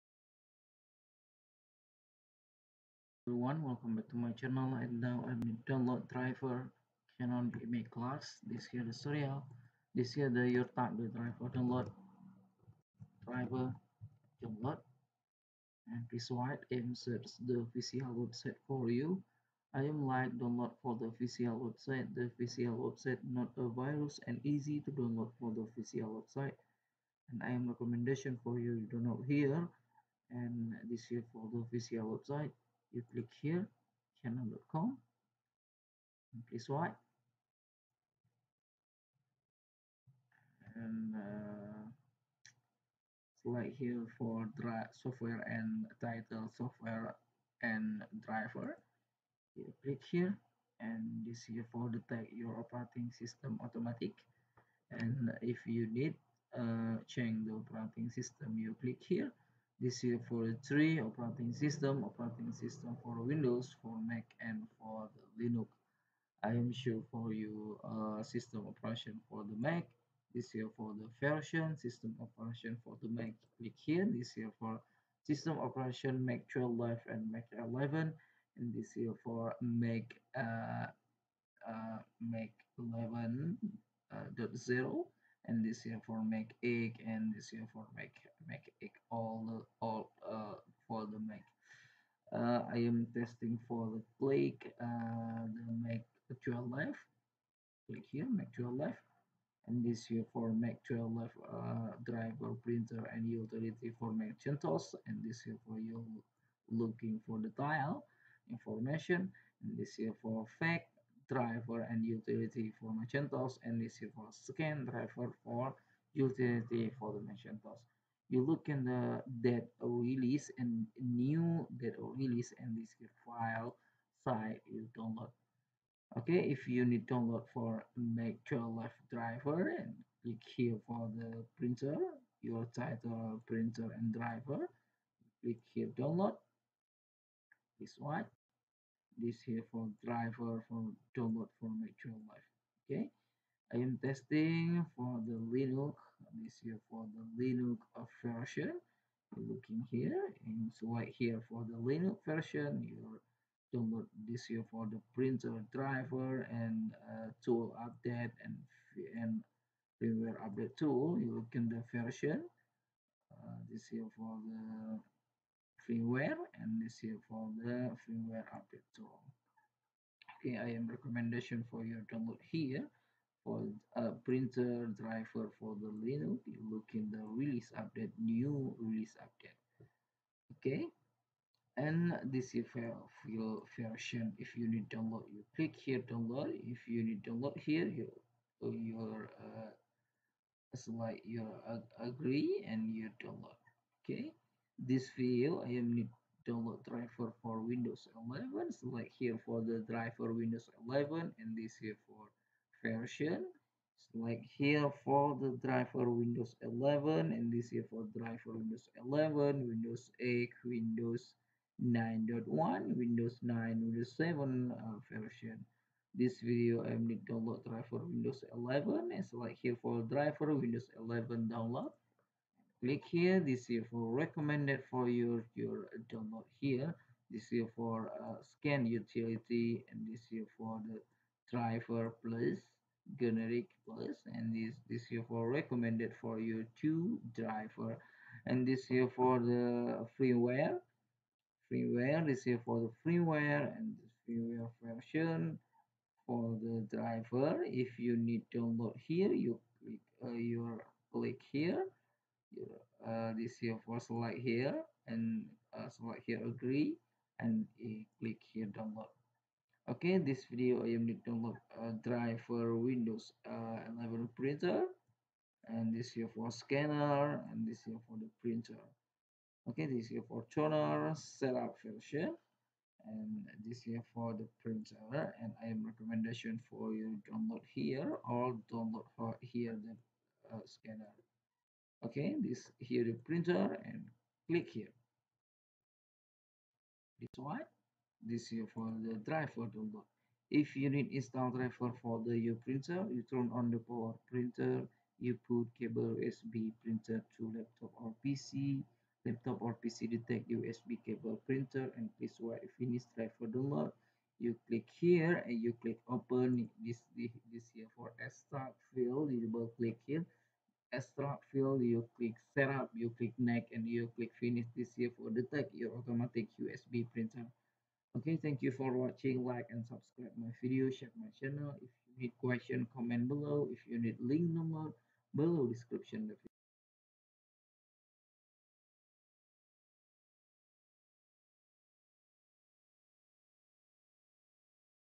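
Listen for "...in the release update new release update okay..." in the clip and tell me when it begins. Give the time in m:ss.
2:56.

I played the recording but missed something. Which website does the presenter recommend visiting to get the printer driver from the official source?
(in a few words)
canon.com.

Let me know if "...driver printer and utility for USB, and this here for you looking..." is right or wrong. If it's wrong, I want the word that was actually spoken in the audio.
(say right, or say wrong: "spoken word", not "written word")
wrong: "Gentos", not "USB".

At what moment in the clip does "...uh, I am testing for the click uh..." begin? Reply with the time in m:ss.
1:32.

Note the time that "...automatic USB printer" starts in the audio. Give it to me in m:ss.
5:15.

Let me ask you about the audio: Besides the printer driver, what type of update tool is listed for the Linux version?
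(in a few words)
firmware update tool.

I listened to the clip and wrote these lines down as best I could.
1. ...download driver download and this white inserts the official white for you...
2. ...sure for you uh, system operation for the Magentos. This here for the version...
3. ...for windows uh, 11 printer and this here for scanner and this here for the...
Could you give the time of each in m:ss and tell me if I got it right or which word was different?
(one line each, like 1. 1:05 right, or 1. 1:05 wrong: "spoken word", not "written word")
1. 0:11 wrong: "website", not "white"
2. 1:06 wrong: "Mac", not "Magentos"
3. 4:22 right.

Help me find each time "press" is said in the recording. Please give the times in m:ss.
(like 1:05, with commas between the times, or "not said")
0:36.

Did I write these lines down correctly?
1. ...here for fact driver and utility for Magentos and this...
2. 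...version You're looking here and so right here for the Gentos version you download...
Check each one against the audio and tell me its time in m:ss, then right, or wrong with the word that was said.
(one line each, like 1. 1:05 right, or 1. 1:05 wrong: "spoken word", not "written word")
1. 1:49 right
2. 2:28 wrong: "Linux", not "Gentos".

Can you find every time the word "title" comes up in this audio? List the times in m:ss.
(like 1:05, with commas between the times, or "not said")
0:46, 2:12.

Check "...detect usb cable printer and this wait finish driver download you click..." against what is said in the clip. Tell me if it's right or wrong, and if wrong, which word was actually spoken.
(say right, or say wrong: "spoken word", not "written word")
right.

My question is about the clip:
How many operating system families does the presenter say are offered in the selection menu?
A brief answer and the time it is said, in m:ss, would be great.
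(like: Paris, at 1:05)
3, at 1:00.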